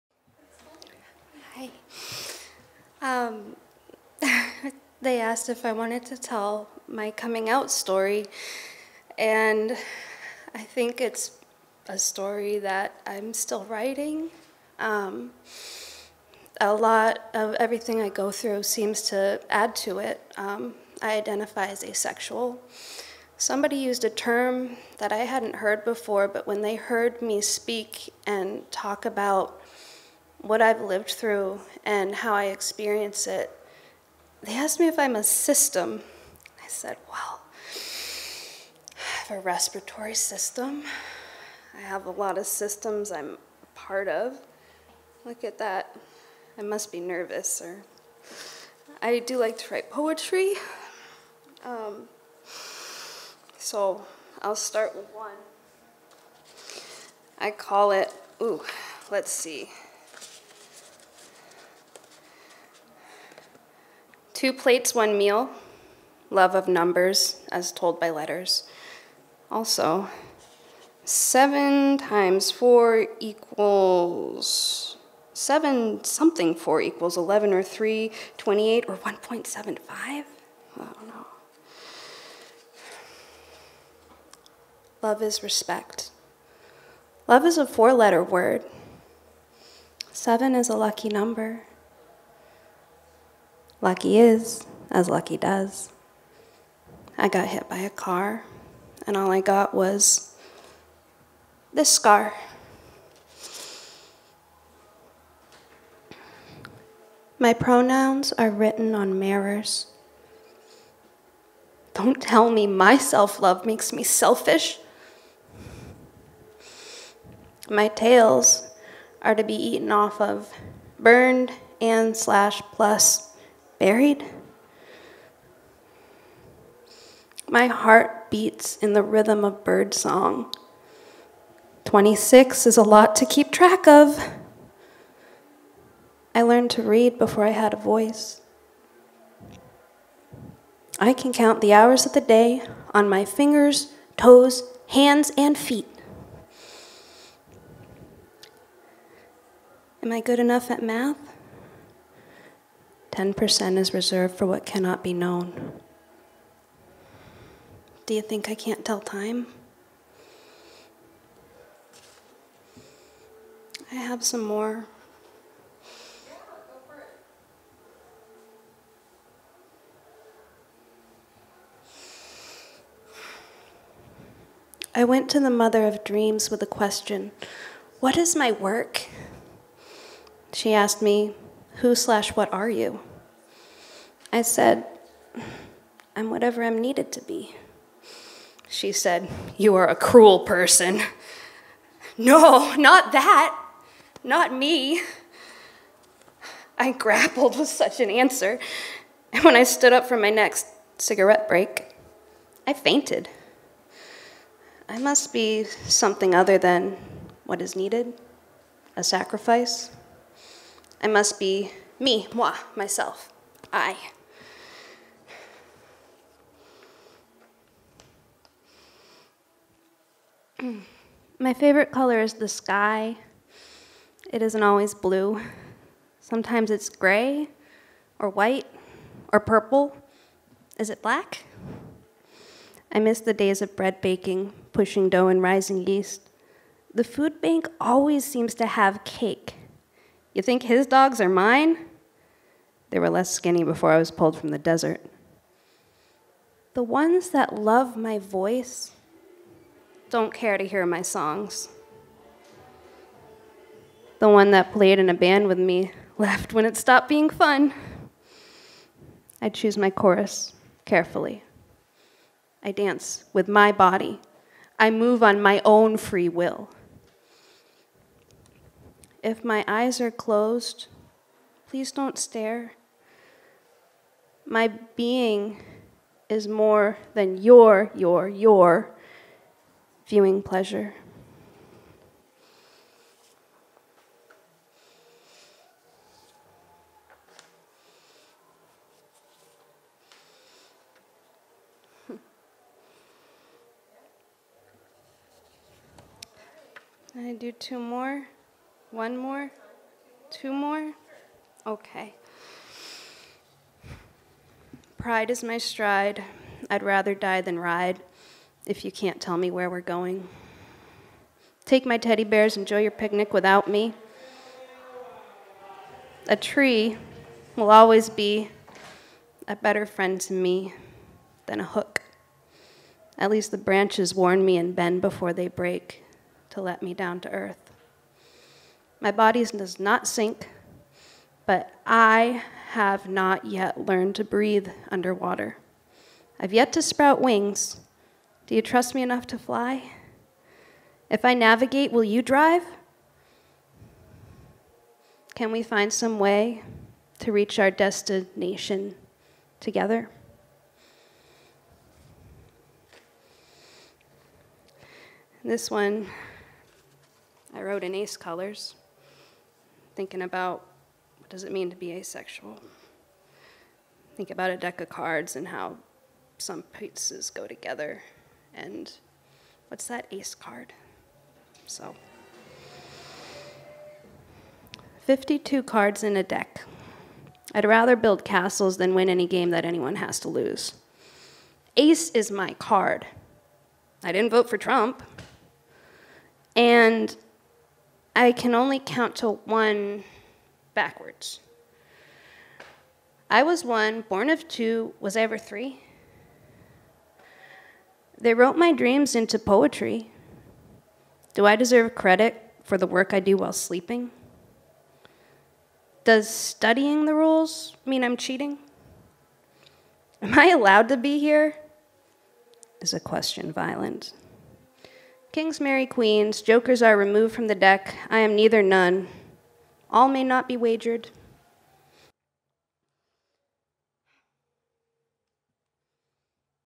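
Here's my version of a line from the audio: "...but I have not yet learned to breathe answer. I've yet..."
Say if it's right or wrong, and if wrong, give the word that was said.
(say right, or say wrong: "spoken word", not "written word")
wrong: "underwater", not "answer".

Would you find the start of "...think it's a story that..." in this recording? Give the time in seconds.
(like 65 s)
10 s.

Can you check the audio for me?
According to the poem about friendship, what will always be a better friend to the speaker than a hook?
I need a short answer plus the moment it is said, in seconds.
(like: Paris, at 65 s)
a tree, at 316 s.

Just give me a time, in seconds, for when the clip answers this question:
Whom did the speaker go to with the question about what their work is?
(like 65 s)
175 s.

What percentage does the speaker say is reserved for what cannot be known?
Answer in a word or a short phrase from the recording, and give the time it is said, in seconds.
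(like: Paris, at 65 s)
10%, at 153 s.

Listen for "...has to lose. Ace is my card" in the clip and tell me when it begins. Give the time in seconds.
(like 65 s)
379 s.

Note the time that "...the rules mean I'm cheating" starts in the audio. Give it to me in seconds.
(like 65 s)
407 s.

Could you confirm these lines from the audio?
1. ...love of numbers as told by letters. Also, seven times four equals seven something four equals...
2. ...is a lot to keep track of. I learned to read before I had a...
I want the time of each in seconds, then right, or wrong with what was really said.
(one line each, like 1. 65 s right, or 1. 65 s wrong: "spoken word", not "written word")
1. 66 s right
2. 132 s right.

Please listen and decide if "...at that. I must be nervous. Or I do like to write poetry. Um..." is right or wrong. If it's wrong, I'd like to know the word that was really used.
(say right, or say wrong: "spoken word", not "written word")
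right.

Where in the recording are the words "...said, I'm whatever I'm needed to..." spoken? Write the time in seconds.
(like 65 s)
184 s.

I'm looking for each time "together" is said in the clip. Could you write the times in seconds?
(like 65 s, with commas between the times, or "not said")
349 s, 367 s.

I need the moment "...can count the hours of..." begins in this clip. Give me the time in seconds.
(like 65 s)
141 s.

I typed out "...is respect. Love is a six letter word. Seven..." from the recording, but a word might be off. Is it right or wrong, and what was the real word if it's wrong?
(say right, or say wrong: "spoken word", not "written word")
wrong: "four", not "six".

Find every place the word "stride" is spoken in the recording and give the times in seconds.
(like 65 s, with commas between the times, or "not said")
305 s.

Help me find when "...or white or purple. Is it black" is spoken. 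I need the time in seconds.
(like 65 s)
228 s.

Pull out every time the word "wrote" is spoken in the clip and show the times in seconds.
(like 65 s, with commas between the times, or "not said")
357 s, 398 s.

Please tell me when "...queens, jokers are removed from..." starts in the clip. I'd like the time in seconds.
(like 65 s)
415 s.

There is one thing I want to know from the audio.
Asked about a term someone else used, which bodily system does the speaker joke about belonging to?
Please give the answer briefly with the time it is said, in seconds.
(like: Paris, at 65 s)
respiratory system, at 39 s.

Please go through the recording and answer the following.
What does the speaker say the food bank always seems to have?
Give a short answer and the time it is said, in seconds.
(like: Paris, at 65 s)
cake, at 239 s.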